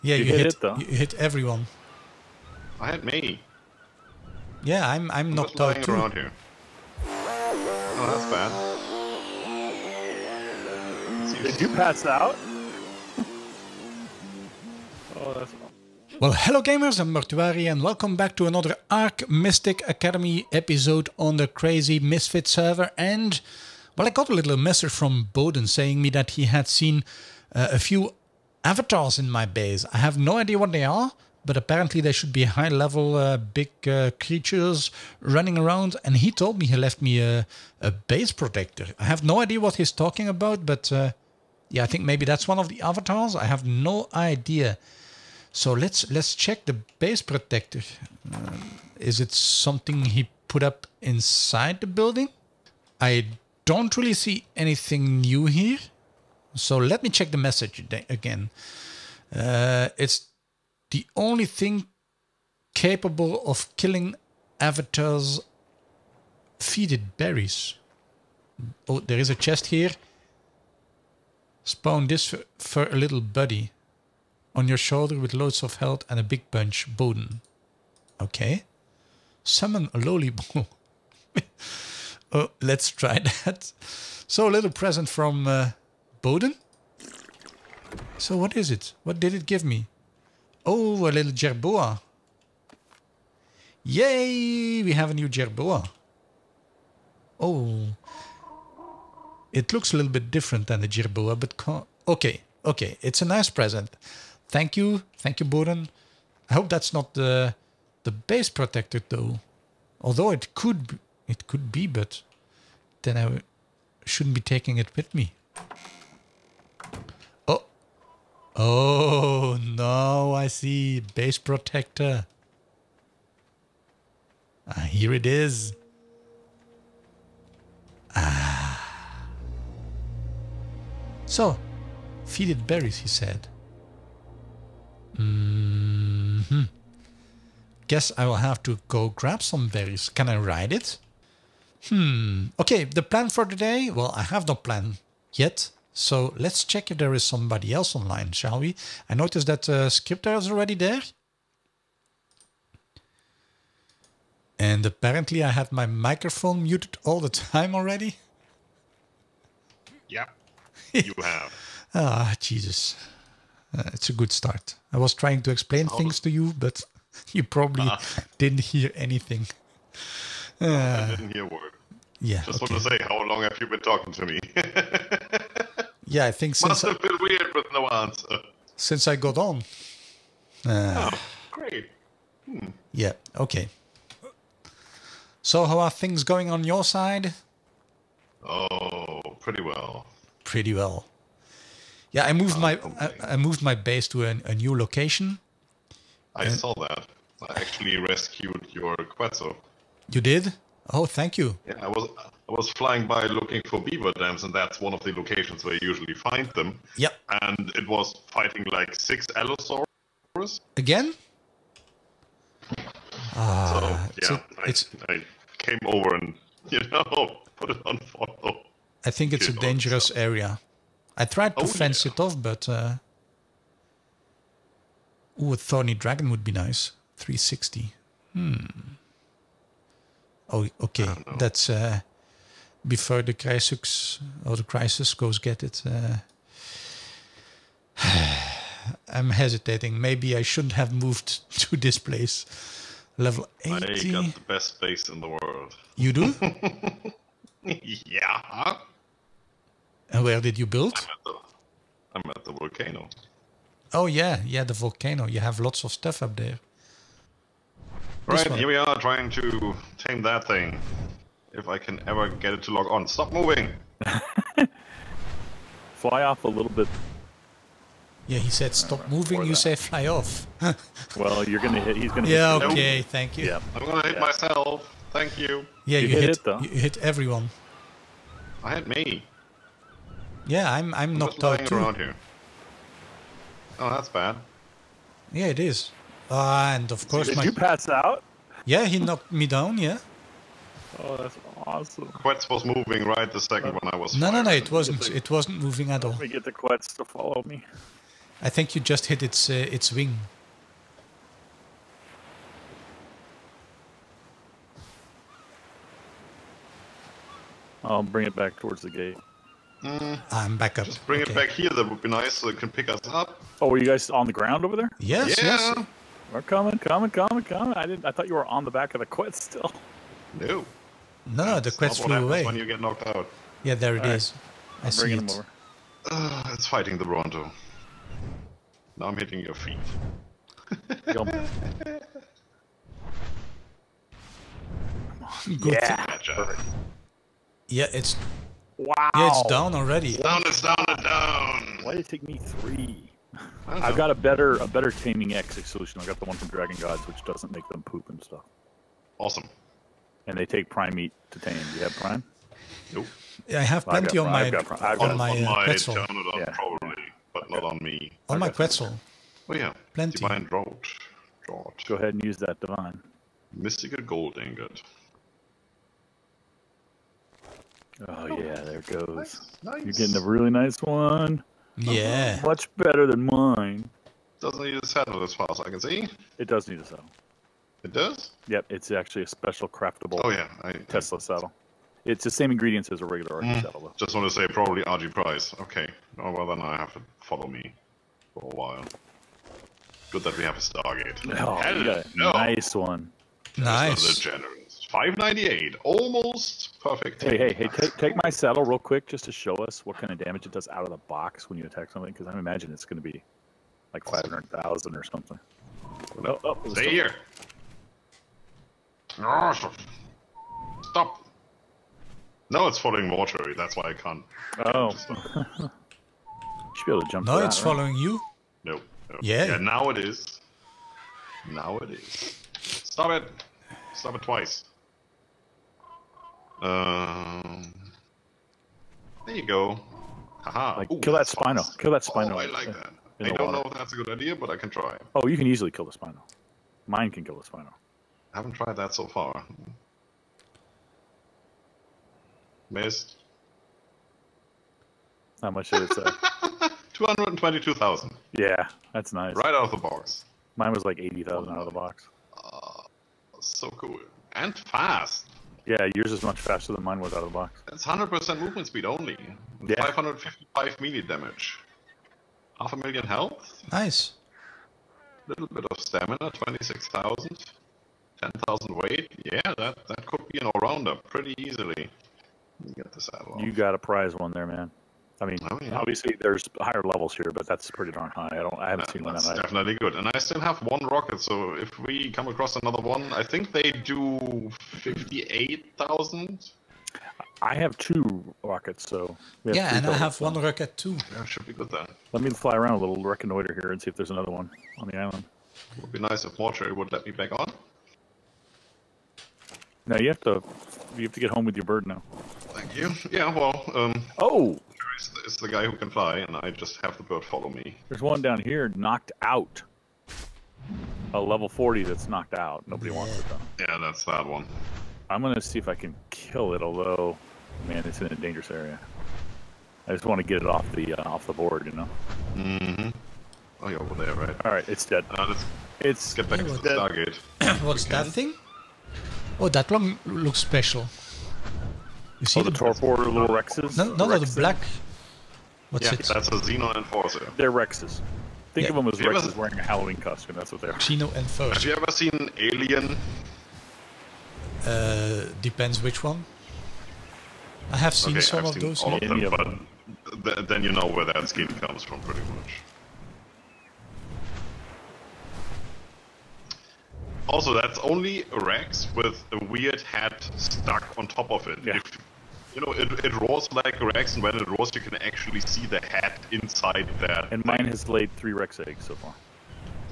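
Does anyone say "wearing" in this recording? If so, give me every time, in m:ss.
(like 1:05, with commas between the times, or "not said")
8:59.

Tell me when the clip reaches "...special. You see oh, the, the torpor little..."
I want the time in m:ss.
8:50.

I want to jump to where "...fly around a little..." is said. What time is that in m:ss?
8:12.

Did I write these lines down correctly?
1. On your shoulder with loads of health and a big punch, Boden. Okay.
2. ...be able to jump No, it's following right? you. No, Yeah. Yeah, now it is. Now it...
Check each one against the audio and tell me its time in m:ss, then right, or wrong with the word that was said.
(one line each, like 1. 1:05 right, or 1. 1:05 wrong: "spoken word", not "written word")
1. 1:14 right
2. 6:56 right.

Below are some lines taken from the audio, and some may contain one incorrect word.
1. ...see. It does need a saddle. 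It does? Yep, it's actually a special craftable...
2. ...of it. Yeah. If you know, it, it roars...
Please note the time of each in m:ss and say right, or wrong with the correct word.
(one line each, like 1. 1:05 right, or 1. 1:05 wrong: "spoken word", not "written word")
1. 6:15 right
2. 9:21 right.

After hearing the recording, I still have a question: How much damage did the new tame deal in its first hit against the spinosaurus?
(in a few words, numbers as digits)
222,000.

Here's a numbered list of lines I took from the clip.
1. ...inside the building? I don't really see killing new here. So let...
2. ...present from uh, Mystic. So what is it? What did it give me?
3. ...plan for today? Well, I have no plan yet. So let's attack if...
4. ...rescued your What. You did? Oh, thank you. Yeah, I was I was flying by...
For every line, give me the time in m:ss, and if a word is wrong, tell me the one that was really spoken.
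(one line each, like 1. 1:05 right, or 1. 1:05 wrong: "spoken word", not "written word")
1. 0:51 wrong: "anything", not "killing"
2. 1:24 wrong: "Boden", not "Mystic"
3. 2:23 wrong: "check", not "attack"
4. 3:17 wrong: "Quetzal", not "What".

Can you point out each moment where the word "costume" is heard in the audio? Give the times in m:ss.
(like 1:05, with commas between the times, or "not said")
8:59.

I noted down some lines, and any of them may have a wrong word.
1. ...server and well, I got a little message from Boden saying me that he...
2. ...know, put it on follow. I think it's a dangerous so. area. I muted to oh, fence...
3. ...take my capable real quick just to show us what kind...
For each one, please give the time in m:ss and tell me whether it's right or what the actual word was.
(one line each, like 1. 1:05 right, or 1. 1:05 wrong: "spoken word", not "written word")
1. 0:22 right
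2. 3:36 wrong: "tried", not "muted"
3. 6:37 wrong: "saddle", not "capable".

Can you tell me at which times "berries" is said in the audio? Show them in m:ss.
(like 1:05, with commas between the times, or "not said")
1:07, 2:12, 2:19.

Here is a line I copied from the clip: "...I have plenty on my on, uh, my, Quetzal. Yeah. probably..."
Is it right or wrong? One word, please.
right.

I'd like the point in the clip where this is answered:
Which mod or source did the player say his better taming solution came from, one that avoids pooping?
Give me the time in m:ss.
5:46.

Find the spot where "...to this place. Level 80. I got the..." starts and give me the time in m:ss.
4:01.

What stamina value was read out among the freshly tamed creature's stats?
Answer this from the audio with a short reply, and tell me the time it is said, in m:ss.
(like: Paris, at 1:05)
26,000, at 7:46.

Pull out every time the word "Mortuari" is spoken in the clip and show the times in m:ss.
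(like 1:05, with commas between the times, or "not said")
0:17, 6:53, 8:16.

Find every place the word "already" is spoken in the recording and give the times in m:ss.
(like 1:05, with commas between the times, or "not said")
2:30, 2:37, 5:39.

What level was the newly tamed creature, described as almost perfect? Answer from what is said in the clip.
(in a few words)
598.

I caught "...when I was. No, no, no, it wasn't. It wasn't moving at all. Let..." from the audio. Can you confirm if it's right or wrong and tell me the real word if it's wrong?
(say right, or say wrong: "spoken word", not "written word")
right.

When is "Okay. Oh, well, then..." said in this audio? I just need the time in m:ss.
6:25.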